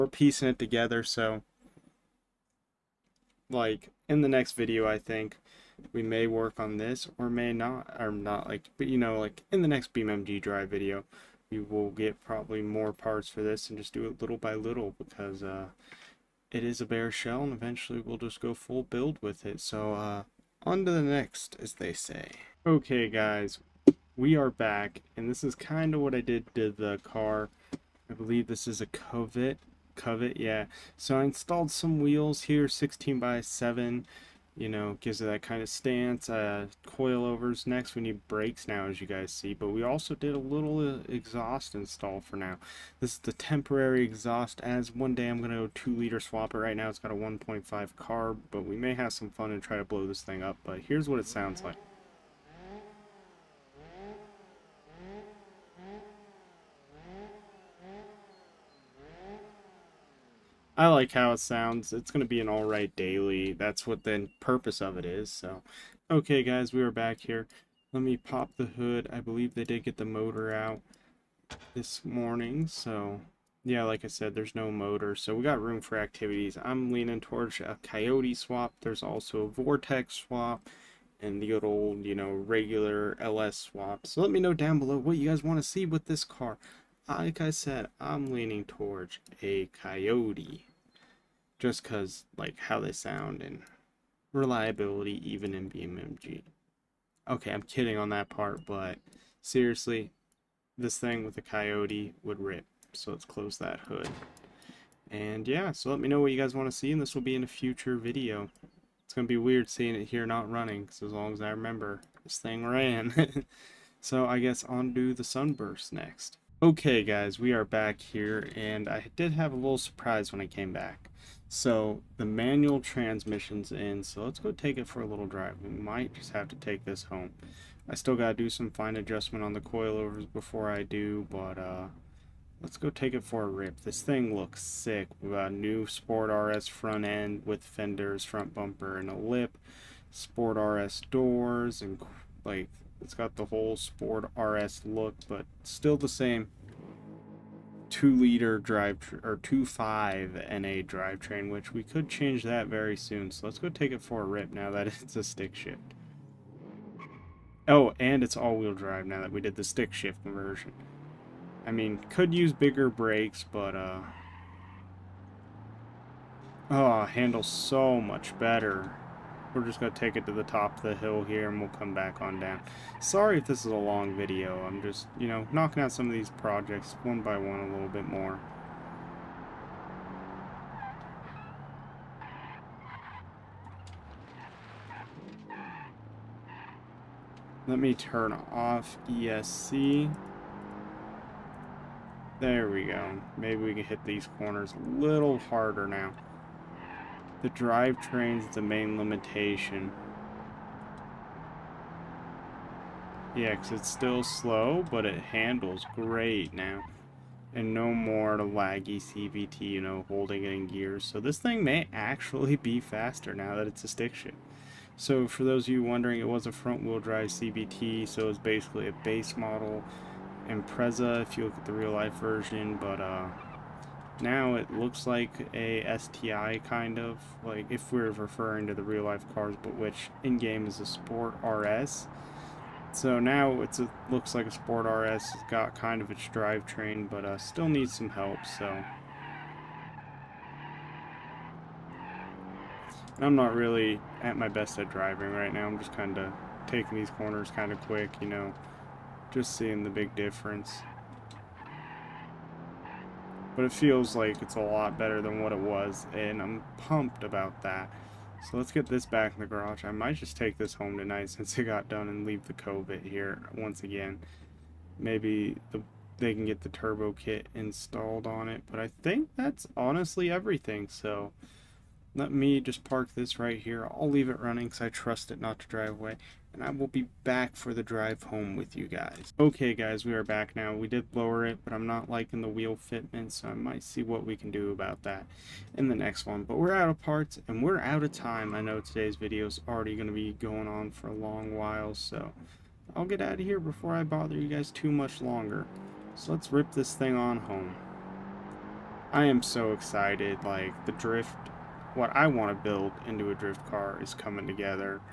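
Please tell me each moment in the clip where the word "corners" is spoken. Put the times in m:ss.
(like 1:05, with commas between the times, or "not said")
3:14, 4:07.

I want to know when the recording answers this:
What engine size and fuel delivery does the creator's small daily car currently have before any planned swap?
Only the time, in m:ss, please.
0:47.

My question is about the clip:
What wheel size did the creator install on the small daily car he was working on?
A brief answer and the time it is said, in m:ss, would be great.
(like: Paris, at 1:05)
16 by 7, at 0:32.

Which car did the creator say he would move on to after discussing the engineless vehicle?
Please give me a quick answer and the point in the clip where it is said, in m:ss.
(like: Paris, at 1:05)
Sunburst, at 1:55.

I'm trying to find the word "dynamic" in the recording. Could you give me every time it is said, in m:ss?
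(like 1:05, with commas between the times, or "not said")
not said.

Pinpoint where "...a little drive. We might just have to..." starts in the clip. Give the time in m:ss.
2:05.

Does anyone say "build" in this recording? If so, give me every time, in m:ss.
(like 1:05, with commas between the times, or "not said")
0:18, 5:02.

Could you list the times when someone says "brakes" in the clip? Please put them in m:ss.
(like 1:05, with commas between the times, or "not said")
0:38, 2:42.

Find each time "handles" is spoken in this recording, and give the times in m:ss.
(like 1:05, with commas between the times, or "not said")
2:47, 3:25.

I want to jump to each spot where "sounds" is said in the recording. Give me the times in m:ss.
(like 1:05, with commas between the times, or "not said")
0:51, 1:01, 1:32.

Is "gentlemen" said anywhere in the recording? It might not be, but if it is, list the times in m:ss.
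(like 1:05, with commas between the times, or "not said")
not said.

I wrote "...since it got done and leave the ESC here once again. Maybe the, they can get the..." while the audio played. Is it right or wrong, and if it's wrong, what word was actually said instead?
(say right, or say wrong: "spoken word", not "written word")
wrong: "Covet", not "ESC".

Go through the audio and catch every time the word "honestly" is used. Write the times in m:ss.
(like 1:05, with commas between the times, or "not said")
4:29.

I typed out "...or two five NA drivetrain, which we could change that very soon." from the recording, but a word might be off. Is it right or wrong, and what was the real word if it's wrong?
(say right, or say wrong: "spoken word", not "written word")
right.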